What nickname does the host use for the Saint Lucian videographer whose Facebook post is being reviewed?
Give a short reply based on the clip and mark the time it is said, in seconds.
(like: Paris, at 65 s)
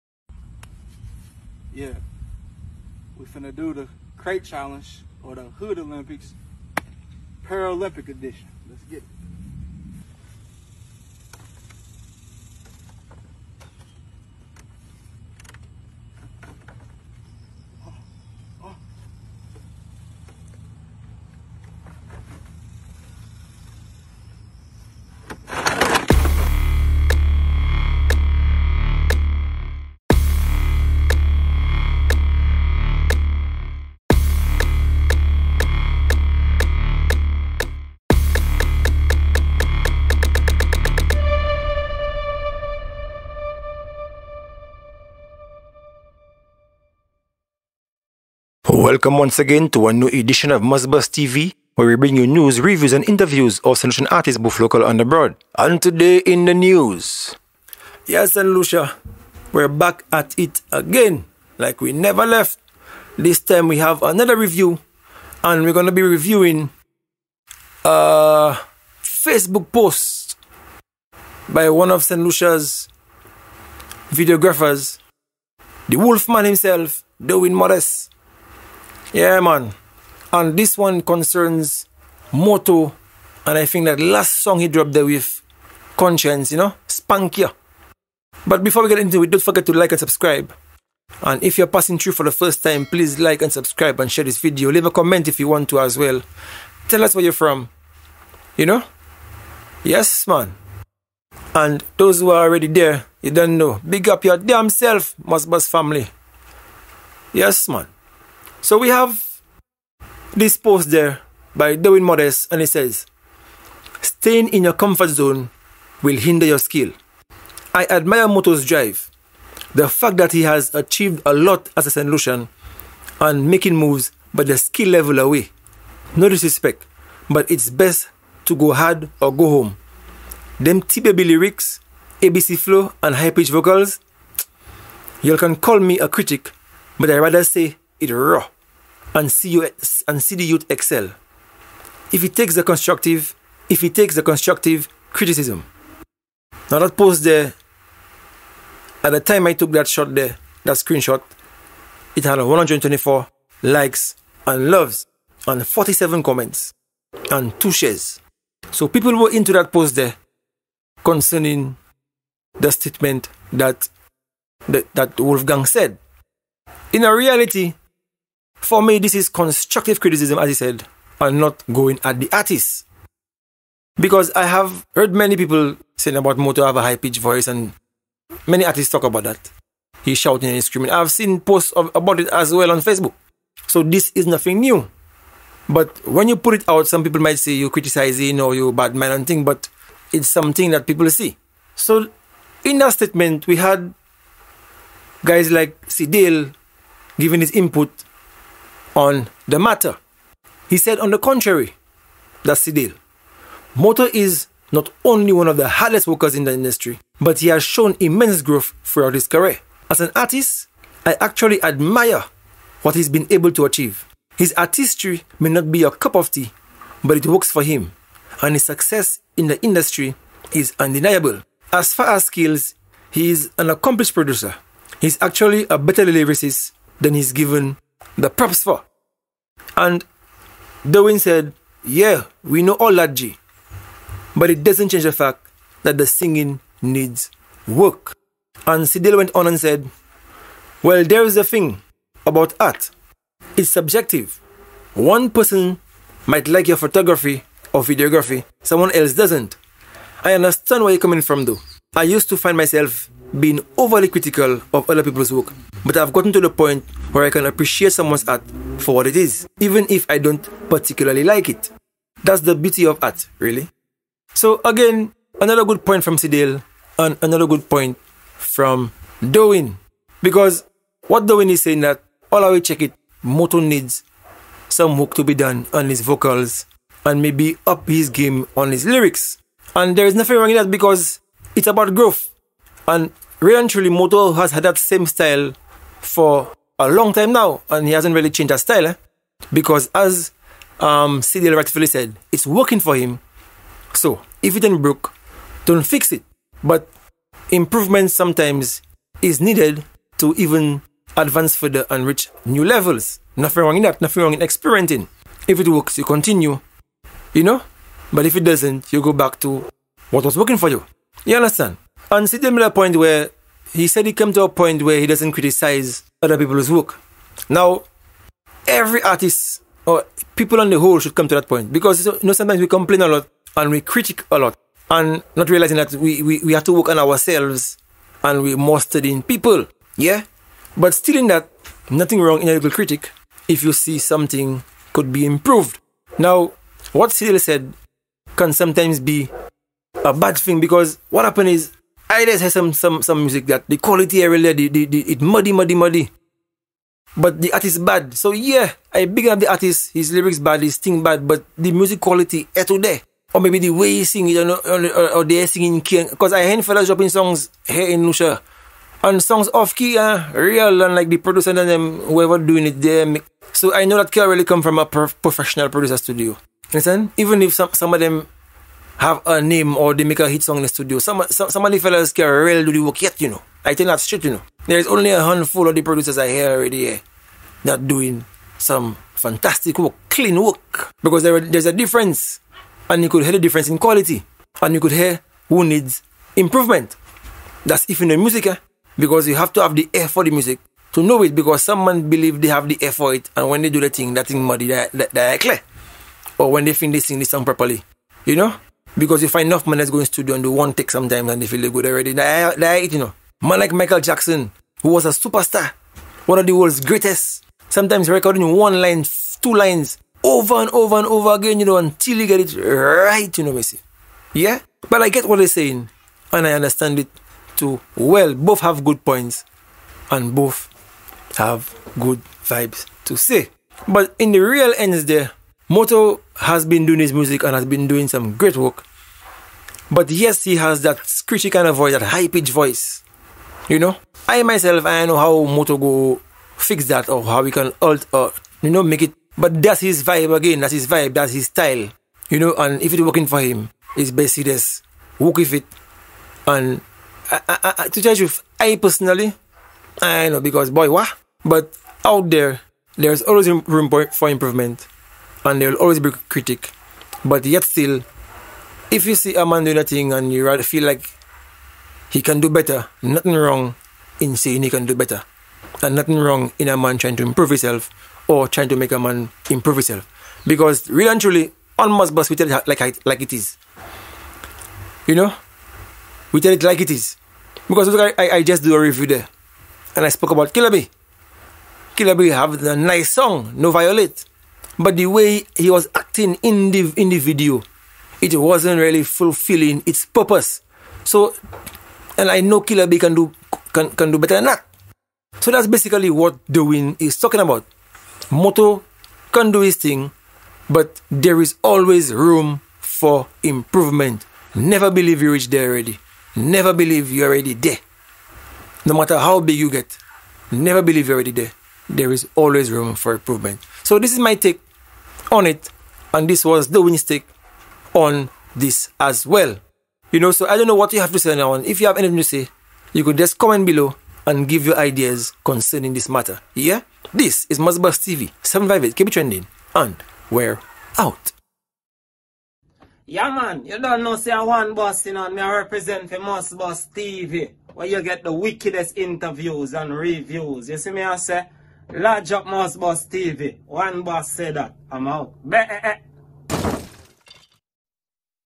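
Wolfman, at 75 s.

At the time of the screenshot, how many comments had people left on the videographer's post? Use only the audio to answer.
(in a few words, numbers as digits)
47.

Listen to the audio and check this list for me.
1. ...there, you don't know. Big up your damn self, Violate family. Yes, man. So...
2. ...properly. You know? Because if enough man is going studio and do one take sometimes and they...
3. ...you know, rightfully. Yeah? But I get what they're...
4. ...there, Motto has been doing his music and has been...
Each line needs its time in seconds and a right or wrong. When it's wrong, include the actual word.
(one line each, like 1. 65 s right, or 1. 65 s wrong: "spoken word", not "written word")
1. 102 s wrong: "MussBuss", not "Violate"
2. 397 s right
3. 413 s wrong: "basically", not "rightfully"
4. 425 s right.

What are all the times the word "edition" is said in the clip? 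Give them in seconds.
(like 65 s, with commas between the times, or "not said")
8 s, 50 s.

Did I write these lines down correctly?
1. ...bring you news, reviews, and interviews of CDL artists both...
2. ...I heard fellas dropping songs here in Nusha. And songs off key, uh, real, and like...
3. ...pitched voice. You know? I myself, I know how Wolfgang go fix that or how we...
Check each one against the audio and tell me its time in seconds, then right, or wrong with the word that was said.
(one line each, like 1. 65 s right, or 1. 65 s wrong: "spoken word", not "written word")
1. 51 s wrong: "Saint", not "CDL"
2. 356 s right
3. 432 s wrong: "Motto", not "Wolfgang".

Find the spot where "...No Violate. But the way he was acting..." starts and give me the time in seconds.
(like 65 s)
483 s.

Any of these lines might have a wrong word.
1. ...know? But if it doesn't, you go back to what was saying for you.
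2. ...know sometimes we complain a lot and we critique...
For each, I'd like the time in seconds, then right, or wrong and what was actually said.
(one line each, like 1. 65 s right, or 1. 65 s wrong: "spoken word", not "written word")
1. 307 s wrong: "working", not "saying"
2. 322 s right.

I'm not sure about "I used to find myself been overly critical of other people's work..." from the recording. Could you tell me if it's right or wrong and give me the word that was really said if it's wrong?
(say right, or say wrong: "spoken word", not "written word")
right.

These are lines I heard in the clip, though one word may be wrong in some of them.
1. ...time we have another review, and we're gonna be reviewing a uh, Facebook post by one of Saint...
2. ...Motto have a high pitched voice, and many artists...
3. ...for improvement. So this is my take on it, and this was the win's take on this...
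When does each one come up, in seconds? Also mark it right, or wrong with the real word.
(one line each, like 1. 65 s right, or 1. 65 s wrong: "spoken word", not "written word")
1. 63 s right
2. 176 s right
3. 512 s right.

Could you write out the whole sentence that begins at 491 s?
So, and I know Killer B can do, can, can do better than that.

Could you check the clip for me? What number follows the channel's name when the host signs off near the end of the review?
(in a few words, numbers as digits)
758.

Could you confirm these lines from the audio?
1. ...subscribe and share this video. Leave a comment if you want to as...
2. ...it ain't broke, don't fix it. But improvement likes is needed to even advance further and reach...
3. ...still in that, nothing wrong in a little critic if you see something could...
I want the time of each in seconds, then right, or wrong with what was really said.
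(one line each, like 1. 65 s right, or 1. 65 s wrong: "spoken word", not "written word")
1. 93 s right
2. 294 s wrong: "sometimes", not "likes"
3. 330 s right.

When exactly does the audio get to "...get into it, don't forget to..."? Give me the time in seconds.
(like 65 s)
88 s.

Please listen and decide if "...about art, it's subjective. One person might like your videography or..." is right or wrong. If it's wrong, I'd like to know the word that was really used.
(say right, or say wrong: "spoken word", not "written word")
wrong: "photography", not "videography".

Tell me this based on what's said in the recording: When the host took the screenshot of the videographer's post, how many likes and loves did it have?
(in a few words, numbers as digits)
124.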